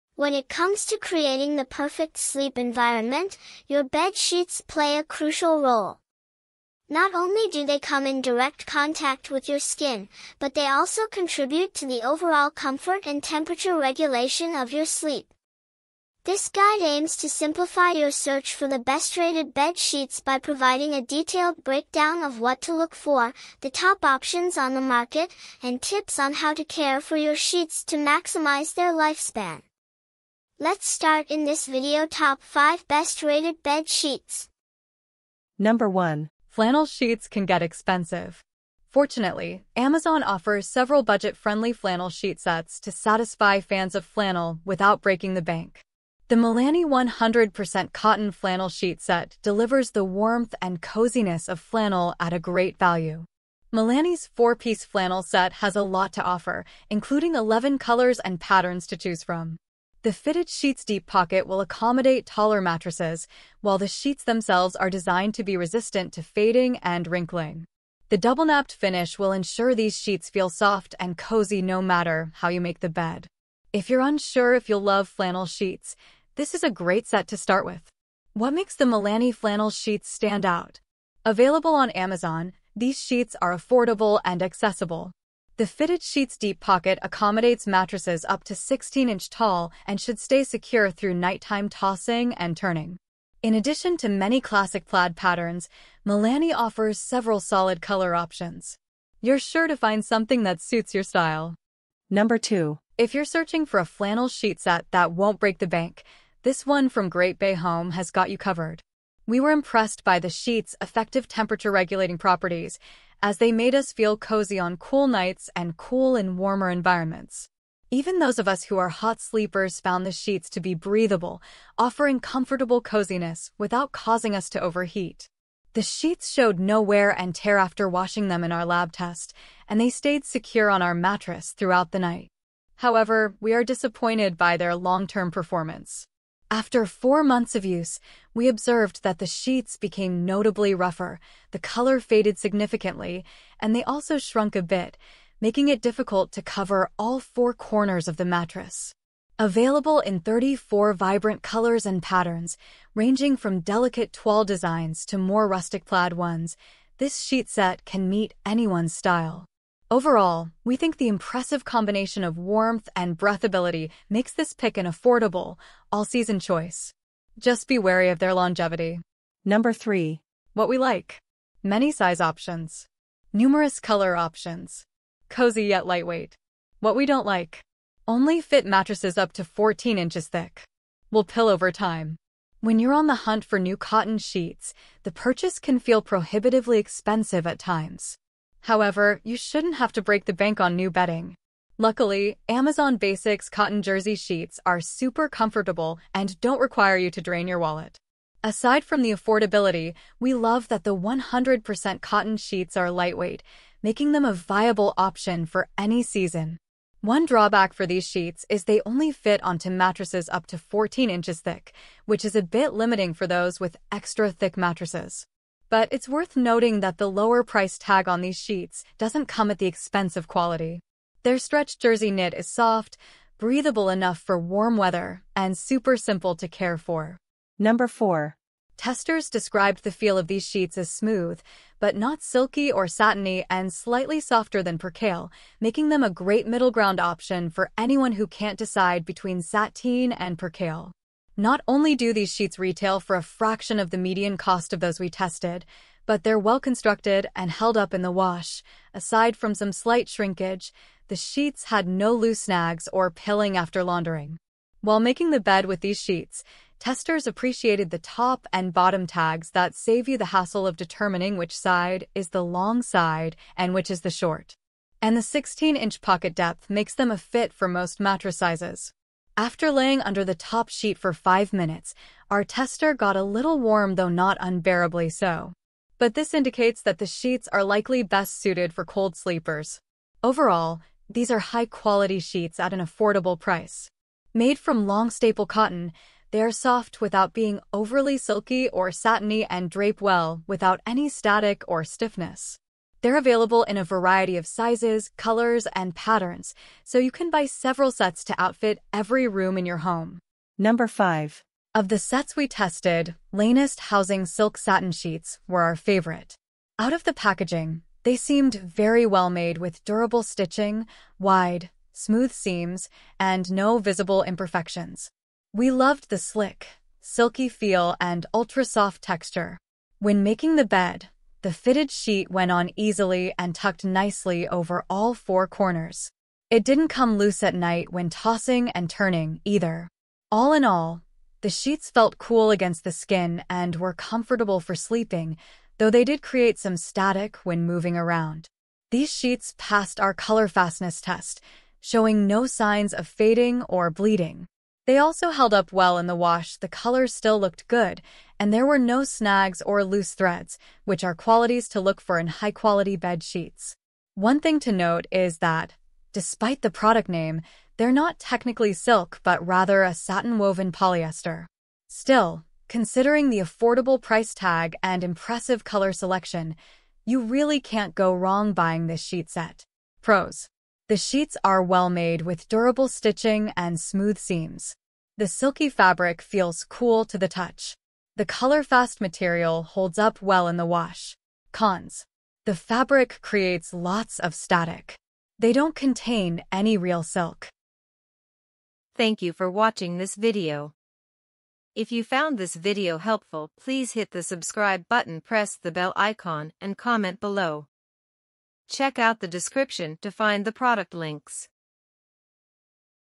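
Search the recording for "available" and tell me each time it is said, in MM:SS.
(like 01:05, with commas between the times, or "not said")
01:21, 02:29, 04:53.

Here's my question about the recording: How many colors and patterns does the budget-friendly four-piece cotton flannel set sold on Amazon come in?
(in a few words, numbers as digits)
11.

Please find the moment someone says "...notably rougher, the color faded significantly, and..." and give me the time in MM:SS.
02:20.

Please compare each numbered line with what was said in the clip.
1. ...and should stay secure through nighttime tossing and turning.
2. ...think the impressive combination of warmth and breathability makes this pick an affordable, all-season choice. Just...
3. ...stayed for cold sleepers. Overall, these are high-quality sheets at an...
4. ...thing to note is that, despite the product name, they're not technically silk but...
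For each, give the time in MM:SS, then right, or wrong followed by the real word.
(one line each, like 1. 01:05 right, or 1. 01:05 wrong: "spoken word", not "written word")
1. 01:29 right
2. 02:40 right
3. 04:38 wrong: "suited", not "stayed"
4. 05:54 right.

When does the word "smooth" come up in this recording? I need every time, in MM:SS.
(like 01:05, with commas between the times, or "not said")
03:50, 05:11, 06:13.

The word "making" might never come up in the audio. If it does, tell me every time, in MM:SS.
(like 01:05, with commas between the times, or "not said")
02:25, 03:23, 03:55, 04:14, 05:20.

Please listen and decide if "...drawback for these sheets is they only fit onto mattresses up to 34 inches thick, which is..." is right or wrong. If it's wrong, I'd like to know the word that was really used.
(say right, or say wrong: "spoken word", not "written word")
wrong: "14", not "34".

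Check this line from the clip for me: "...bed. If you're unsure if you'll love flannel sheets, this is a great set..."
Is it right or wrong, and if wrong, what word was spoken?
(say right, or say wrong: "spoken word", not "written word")
right.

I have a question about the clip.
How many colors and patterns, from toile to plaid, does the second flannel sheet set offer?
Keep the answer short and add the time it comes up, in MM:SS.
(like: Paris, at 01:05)
34, at 02:30.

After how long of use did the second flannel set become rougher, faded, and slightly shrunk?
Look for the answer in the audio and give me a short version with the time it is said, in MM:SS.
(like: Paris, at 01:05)
4 months, at 02:16.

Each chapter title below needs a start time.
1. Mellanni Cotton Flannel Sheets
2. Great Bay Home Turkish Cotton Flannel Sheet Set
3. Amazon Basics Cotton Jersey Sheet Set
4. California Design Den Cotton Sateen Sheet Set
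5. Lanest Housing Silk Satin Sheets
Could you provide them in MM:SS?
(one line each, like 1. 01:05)
1. 00:35
2. 01:41
3. 02:49
4. 03:47
5. 05:00.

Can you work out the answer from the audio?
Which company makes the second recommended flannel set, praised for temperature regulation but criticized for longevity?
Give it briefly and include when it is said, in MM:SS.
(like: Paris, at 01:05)
Great Bay Home, at 01:47.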